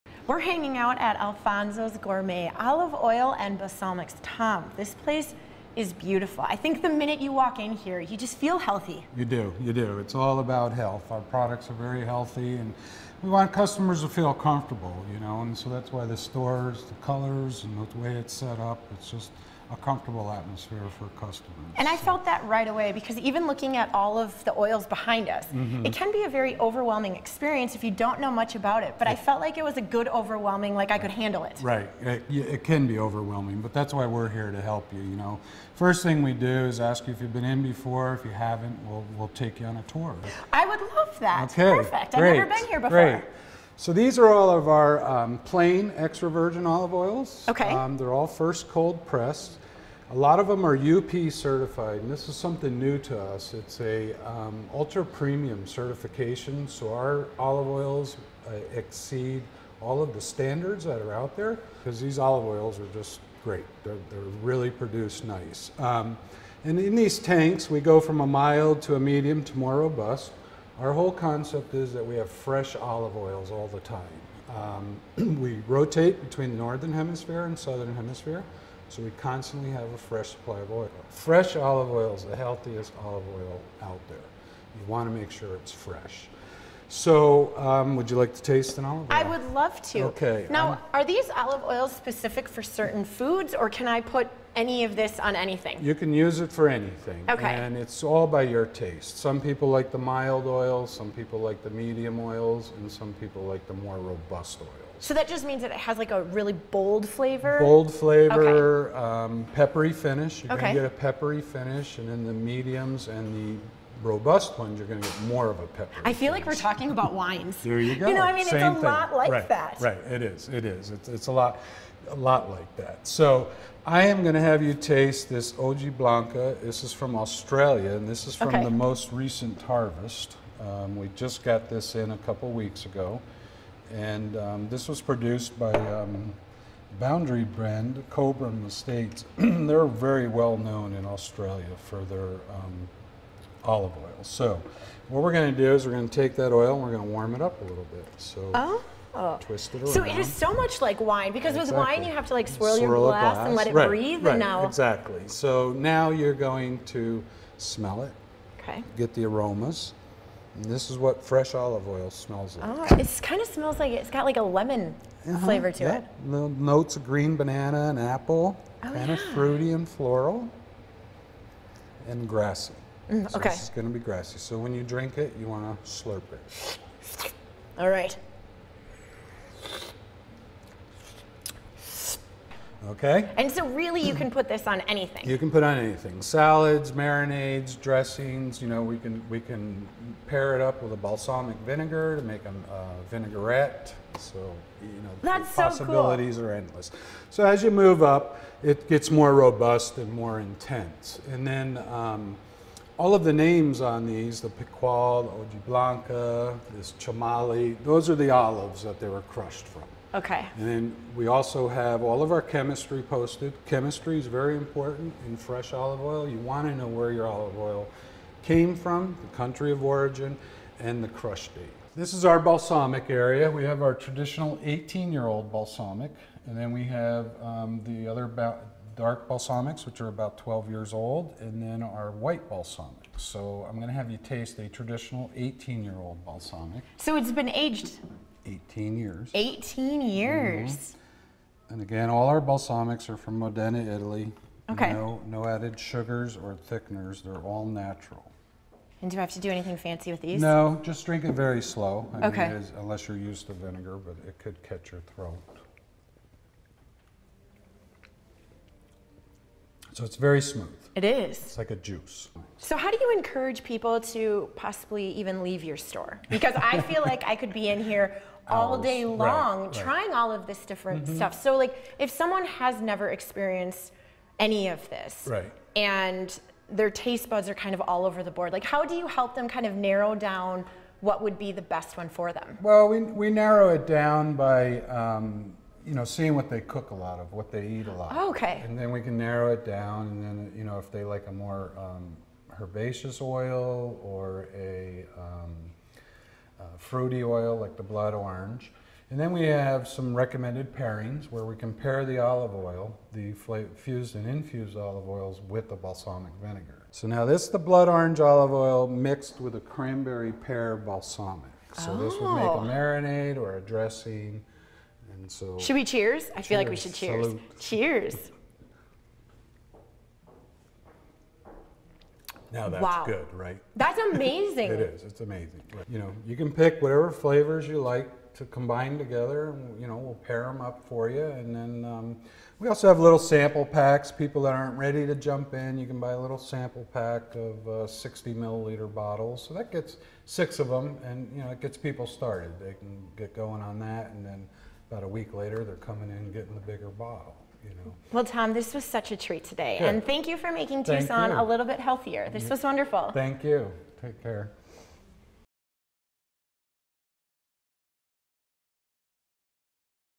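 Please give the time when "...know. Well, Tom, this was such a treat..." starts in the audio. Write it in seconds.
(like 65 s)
347 s.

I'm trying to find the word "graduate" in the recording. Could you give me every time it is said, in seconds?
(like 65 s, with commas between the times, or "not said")
not said.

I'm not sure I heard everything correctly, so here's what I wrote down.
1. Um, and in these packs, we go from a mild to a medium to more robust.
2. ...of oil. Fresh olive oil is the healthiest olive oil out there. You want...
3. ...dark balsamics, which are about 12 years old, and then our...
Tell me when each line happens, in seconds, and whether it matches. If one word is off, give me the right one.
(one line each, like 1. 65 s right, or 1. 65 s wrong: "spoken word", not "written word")
1. 65 s wrong: "tanks", not "packs"
2. 80 s right
3. 228 s right.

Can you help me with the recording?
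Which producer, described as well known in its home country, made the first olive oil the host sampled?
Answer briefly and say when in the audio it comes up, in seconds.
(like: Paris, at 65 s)
Cobram Estates, at 138 s.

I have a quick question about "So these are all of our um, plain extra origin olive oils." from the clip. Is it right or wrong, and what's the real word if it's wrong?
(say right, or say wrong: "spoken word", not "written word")
wrong: "virgin", not "origin".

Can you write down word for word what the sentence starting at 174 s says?
So when you drink it, you want to slurp it.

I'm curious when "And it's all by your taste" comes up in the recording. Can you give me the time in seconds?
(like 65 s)
97 s.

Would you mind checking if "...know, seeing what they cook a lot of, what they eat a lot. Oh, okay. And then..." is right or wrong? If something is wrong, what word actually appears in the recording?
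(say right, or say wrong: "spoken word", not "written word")
right.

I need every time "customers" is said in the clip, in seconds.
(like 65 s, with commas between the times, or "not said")
13 s, 21 s.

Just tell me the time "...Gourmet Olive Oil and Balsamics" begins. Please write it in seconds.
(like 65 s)
1 s.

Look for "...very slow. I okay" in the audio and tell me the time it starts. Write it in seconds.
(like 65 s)
251 s.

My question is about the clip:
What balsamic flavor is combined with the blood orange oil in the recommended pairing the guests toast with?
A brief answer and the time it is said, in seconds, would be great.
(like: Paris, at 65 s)
cranberry pear, at 309 s.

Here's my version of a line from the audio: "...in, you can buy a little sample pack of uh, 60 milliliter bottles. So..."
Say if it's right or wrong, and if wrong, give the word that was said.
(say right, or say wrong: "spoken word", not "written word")
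right.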